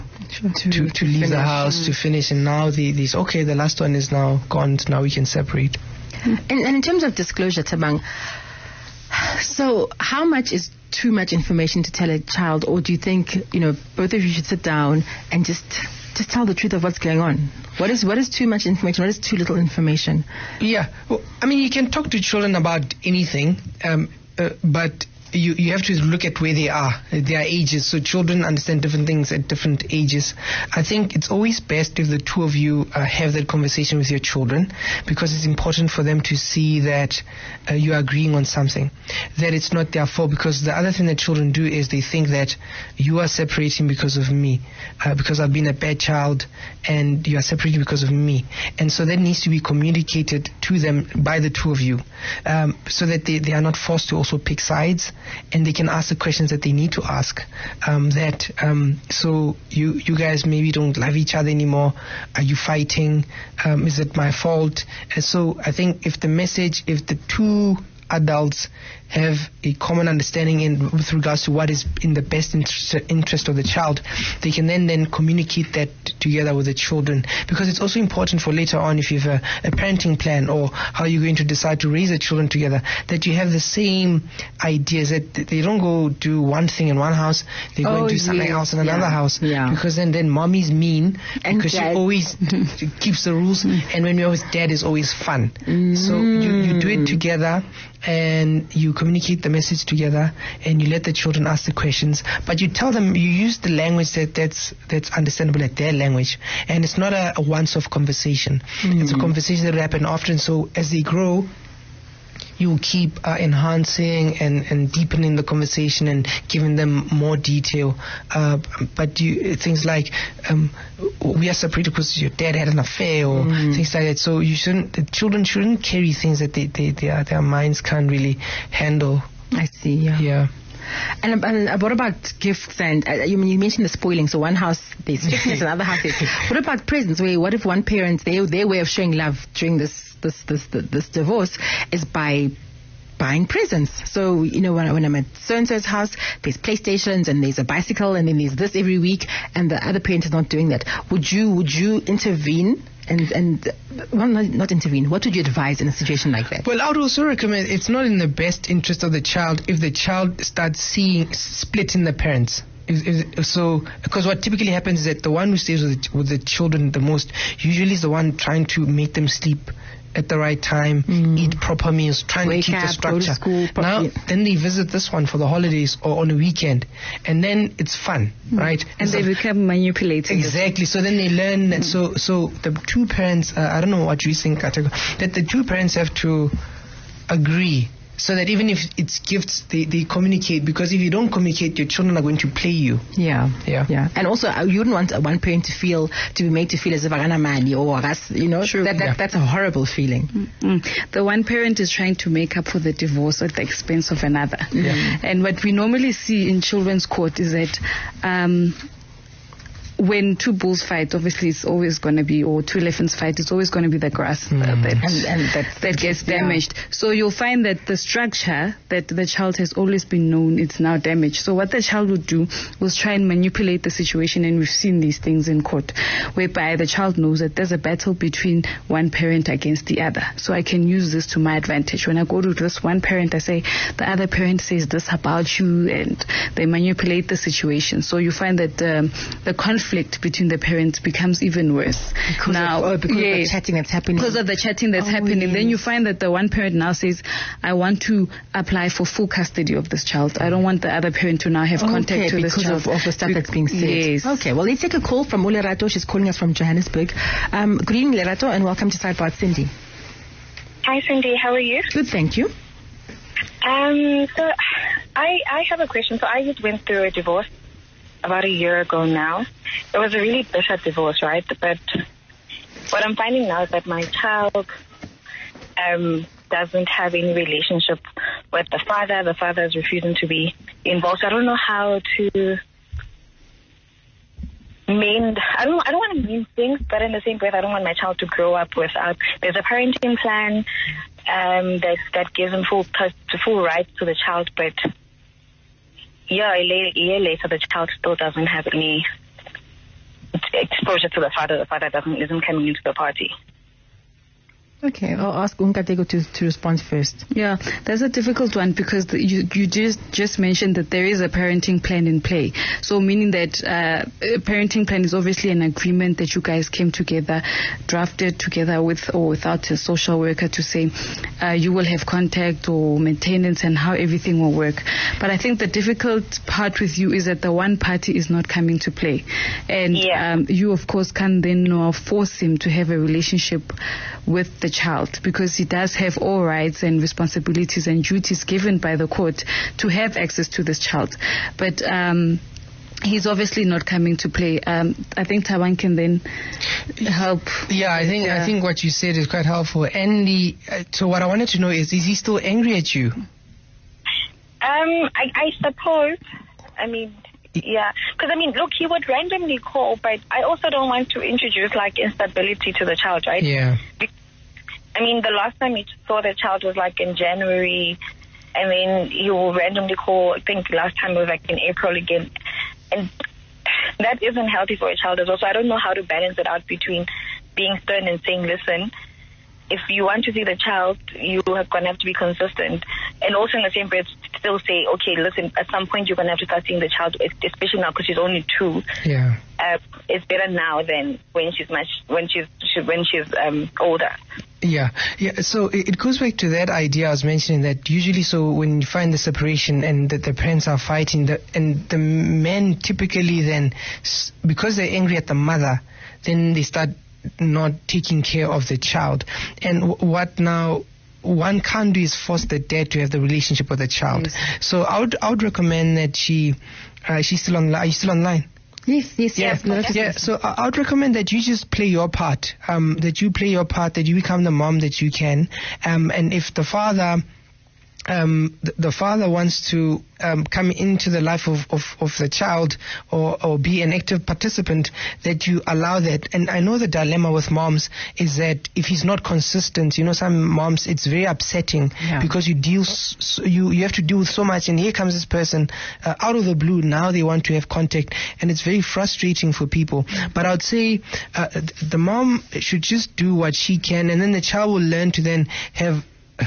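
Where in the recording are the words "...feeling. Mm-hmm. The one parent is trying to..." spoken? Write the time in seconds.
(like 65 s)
199 s.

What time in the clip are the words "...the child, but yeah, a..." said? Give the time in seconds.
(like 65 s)
294 s.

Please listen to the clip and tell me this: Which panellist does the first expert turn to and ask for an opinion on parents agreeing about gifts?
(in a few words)
Kateko.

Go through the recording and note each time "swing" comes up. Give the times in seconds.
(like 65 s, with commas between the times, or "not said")
not said.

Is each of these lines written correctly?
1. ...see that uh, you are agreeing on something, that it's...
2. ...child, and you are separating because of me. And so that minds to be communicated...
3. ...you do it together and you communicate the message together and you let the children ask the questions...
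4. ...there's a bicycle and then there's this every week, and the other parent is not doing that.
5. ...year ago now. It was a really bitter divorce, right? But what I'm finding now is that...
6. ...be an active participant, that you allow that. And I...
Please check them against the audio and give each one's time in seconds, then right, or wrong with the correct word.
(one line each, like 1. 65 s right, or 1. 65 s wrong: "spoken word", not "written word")
1. 36 s right
2. 45 s wrong: "needs", not "minds"
3. 96 s right
4. 147 s right
5. 268 s right
6. 433 s right.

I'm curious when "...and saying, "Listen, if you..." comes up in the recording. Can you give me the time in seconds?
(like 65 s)
378 s.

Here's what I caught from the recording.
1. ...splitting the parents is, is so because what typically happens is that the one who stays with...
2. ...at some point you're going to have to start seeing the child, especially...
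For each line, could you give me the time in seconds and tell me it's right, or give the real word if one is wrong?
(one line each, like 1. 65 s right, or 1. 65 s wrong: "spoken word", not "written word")
1. 161 s right
2. 385 s right.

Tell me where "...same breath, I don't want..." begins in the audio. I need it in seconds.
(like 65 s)
287 s.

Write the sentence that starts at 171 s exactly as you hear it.
eat proper meals, trying Wake to keep up, the structure.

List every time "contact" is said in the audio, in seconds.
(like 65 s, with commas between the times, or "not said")
251 s, 322 s, 447 s.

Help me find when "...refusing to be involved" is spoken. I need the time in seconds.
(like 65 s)
279 s.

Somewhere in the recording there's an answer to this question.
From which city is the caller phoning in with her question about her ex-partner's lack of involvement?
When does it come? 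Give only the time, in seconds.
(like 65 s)
256 s.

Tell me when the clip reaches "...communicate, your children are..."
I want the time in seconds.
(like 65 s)
191 s.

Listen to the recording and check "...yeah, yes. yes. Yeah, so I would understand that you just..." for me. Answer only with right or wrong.
wrong.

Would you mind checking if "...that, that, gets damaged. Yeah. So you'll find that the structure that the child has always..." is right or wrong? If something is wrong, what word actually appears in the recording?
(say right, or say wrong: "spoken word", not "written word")
right.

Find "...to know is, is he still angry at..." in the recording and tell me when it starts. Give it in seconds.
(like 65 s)
351 s.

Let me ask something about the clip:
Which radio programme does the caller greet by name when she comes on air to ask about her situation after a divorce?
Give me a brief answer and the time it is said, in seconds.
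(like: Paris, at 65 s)
Sidebar Sindi, at 258 s.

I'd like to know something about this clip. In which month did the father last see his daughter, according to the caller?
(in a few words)
January.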